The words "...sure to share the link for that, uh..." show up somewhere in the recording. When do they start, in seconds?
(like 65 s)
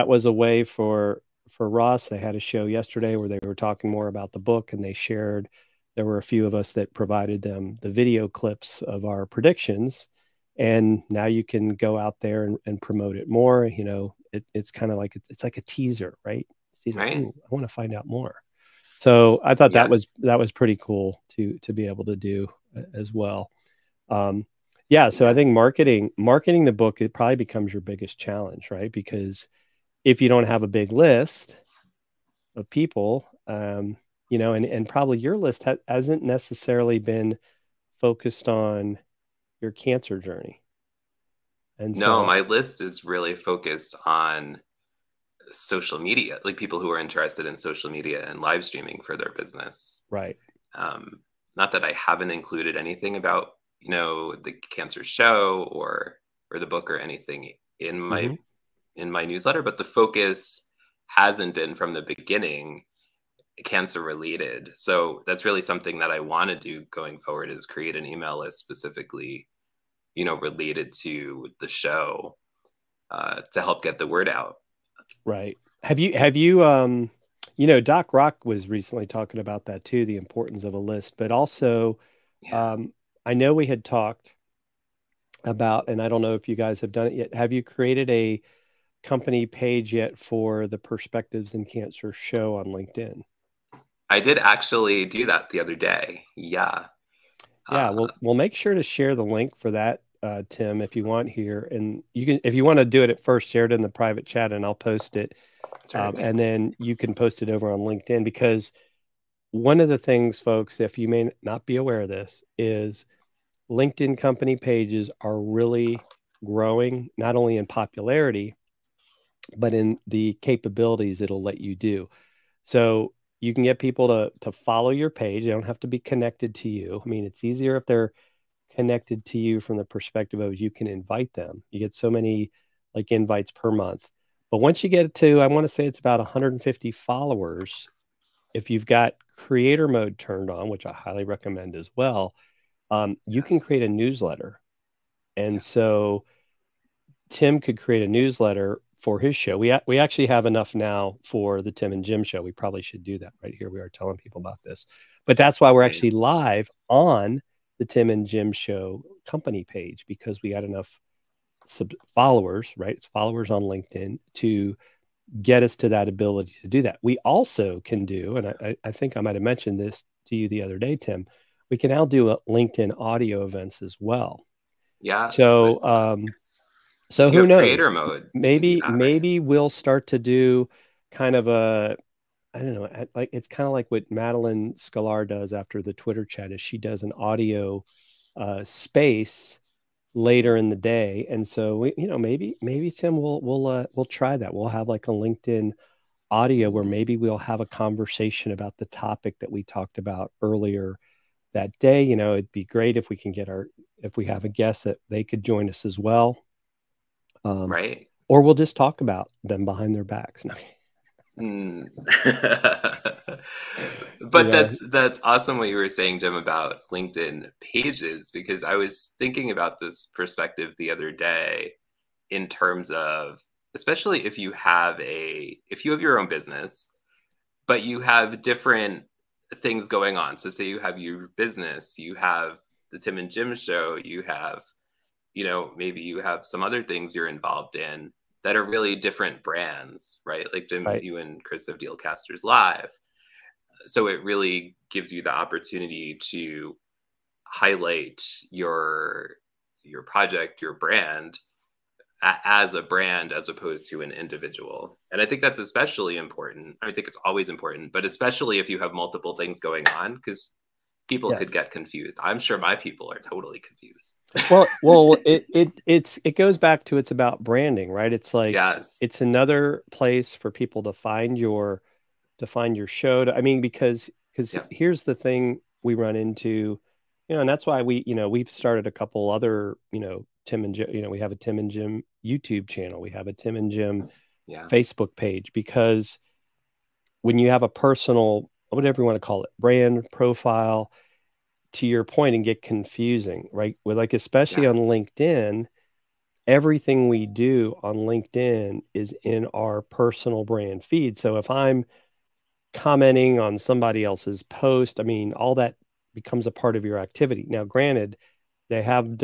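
98 s.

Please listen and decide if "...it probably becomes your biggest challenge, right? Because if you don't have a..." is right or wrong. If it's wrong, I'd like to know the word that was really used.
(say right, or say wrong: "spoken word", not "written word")
right.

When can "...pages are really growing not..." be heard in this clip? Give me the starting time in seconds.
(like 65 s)
114 s.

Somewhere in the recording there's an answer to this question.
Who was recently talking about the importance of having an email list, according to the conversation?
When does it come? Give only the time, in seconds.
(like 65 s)
77 s.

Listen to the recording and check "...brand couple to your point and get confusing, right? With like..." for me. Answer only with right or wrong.
wrong.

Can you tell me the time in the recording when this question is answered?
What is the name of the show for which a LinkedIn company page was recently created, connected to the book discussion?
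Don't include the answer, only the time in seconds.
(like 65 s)
90 s.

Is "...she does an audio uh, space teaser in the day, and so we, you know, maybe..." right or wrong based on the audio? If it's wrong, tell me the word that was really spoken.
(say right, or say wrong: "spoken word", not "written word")
wrong: "later", not "teaser".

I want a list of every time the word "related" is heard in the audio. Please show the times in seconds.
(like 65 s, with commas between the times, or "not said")
64 s, 70 s.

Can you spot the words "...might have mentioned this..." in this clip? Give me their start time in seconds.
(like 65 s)
169 s.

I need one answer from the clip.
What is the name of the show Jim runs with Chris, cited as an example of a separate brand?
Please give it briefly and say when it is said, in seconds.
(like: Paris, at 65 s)
Dealcasters Live, at 241 s.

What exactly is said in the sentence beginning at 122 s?
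So you can get people to to follow your page.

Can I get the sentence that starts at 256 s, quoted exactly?
I think it's always important, but especially if you have multiple things going on cuz people yes.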